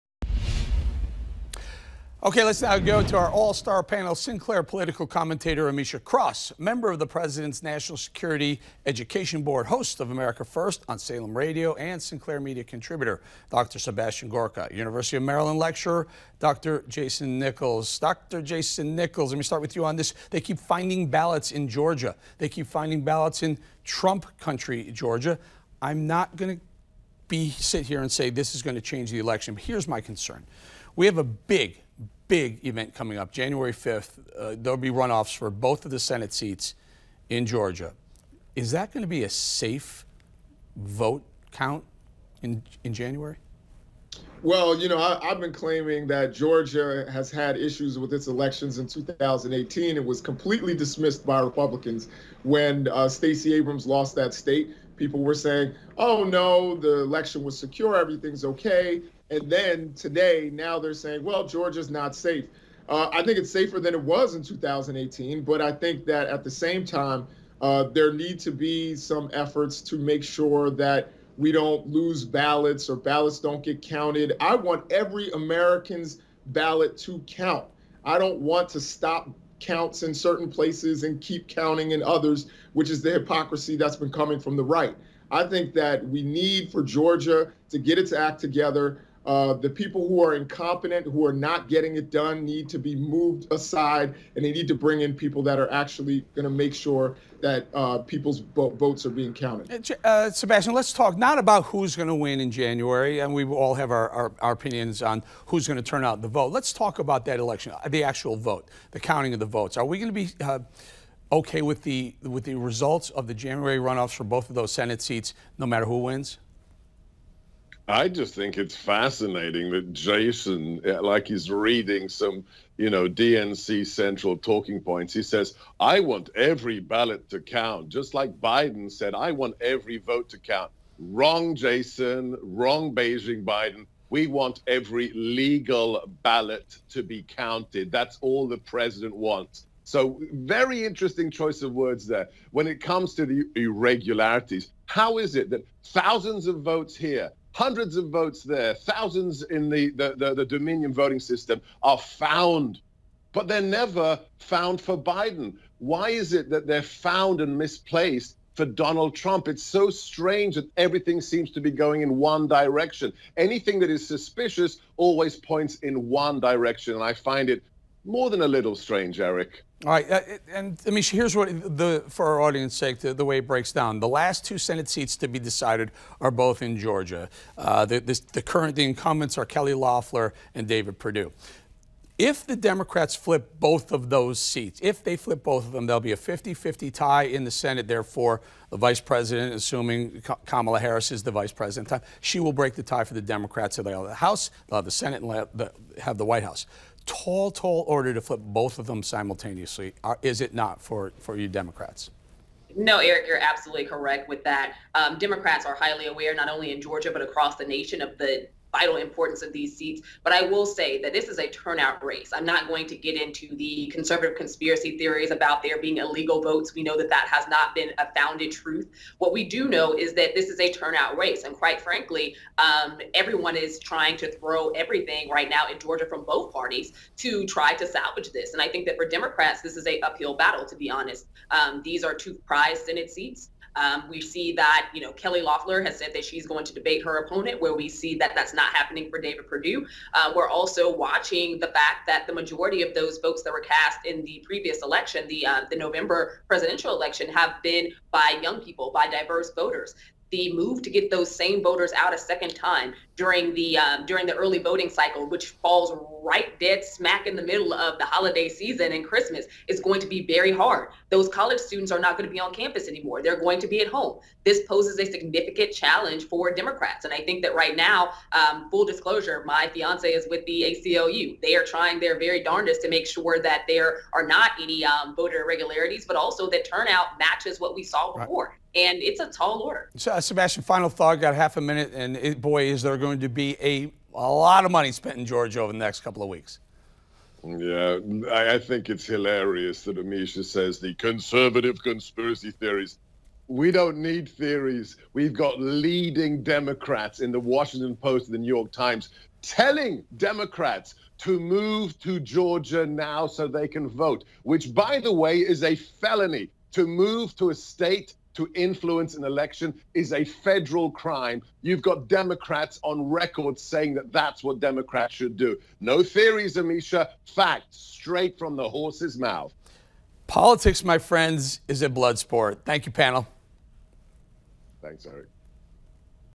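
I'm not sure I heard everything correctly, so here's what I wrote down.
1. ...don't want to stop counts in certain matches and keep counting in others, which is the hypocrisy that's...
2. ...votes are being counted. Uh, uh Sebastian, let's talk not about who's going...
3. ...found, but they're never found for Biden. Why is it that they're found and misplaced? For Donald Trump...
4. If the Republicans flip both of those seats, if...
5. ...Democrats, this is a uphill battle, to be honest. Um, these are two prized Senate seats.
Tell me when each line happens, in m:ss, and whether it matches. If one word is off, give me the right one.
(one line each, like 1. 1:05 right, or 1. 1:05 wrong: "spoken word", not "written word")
1. 1:18 wrong: "places", not "matches"
2. 1:38 right
3. 2:31 right
4. 3:02 wrong: "Democrats", not "Republicans"
5. 3:49 right.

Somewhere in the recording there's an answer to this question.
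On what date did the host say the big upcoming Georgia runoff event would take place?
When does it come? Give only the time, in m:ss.
0:33.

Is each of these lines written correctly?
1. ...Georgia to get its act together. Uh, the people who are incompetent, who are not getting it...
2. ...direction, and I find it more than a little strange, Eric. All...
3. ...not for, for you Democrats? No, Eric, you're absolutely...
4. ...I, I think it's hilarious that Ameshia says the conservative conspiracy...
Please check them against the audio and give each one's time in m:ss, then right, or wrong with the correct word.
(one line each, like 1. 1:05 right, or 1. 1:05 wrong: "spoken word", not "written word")
1. 1:26 right
2. 2:46 right
3. 3:20 right
4. 4:48 right.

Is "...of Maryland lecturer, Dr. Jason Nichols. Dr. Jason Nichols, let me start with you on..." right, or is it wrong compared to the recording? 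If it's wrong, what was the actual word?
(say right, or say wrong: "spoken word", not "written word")
right.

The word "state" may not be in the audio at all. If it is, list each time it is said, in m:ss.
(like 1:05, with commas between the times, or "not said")
0:54, 5:07.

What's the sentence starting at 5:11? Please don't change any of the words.
You've got Democrats on record saying that that's what Democrats should do.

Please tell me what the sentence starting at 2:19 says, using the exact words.
So, very interesting choice of words there.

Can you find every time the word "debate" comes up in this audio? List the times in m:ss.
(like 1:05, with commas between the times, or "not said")
3:56.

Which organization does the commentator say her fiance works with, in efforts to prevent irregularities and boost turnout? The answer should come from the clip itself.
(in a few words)
ACLU.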